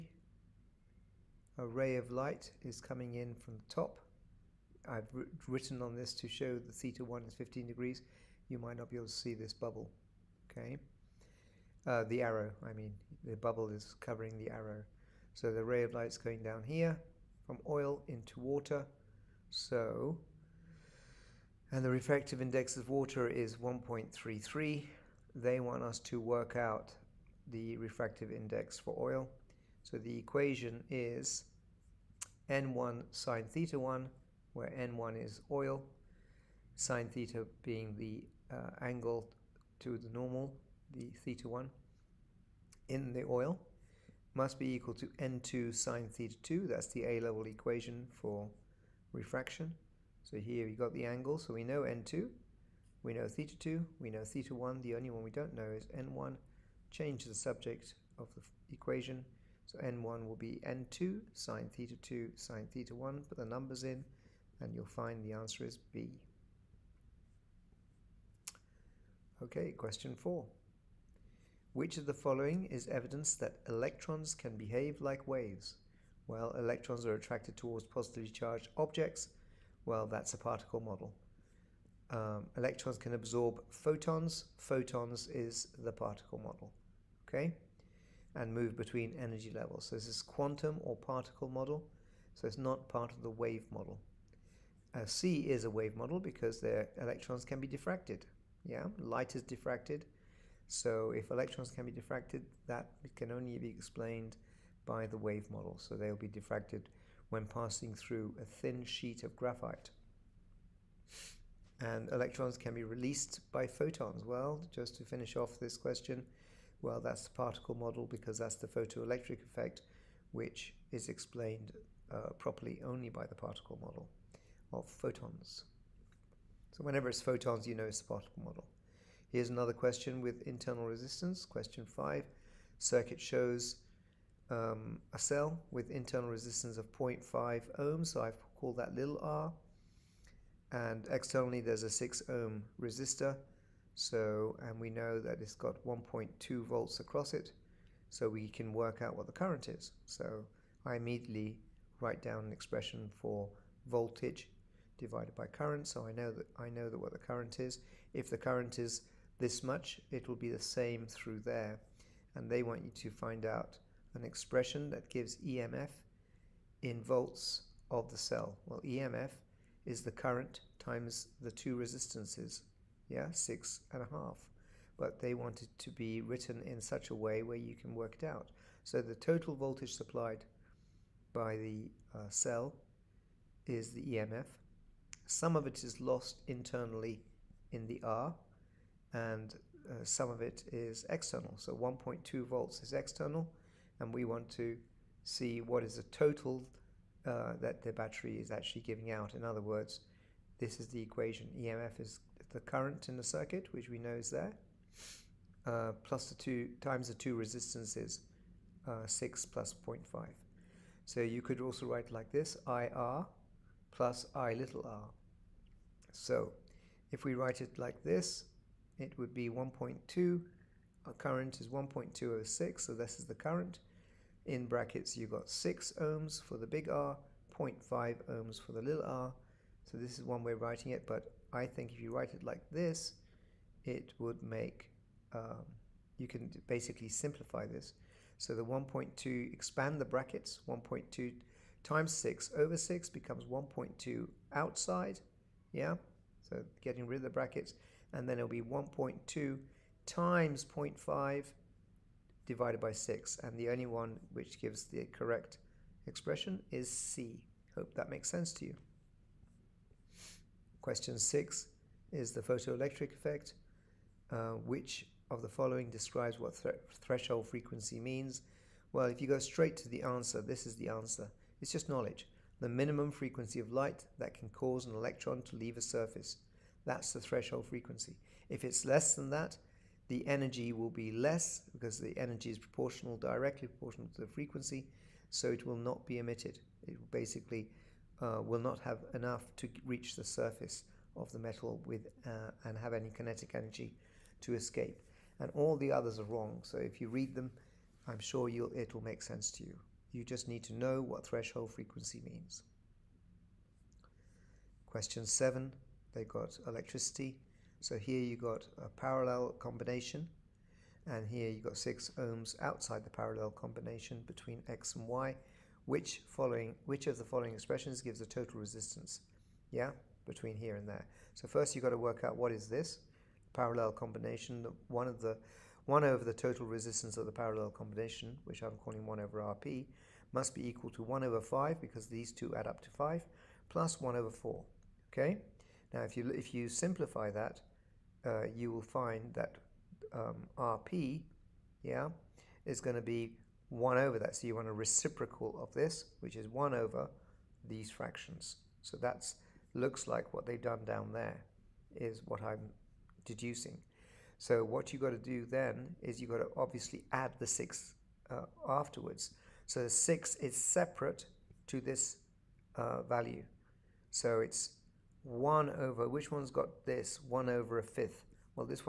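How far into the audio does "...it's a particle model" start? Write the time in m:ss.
2:07.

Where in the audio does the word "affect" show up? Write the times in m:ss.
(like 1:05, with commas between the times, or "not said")
not said.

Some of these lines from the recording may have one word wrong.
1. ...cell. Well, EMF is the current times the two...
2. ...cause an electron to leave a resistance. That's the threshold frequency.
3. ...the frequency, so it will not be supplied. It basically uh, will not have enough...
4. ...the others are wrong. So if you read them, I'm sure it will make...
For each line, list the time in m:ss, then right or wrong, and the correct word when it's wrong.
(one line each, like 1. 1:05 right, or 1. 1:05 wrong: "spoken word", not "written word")
1. 2:48 right
2. 4:34 wrong: "surface", not "resistance"
3. 4:44 wrong: "emitted", not "supplied"
4. 4:55 right.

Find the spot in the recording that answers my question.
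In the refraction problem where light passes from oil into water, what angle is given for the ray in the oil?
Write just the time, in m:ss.
0:07.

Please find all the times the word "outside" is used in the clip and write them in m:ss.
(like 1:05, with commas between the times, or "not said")
4:04, 5:12.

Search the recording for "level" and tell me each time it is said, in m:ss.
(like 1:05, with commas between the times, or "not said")
0:47, 1:29.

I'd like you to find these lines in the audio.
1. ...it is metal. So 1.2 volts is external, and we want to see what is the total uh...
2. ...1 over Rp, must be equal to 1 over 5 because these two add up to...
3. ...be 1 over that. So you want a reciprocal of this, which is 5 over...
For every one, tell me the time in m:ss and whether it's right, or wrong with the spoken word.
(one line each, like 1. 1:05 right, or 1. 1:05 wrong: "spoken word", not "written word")
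1. 3:10 wrong: "external", not "metal"
2. 5:29 right
3. 5:43 wrong: "1", not "5".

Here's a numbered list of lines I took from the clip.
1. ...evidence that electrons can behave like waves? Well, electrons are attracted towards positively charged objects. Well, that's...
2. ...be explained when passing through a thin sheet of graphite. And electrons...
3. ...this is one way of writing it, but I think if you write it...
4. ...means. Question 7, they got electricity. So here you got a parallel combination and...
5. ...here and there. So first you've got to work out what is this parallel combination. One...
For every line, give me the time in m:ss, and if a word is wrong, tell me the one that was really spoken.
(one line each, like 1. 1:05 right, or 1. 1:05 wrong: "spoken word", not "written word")
1. 1:12 right
2. 1:46 wrong: "diffracted", not "explained"
3. 3:49 right
4. 5:02 right
5. 5:20 right.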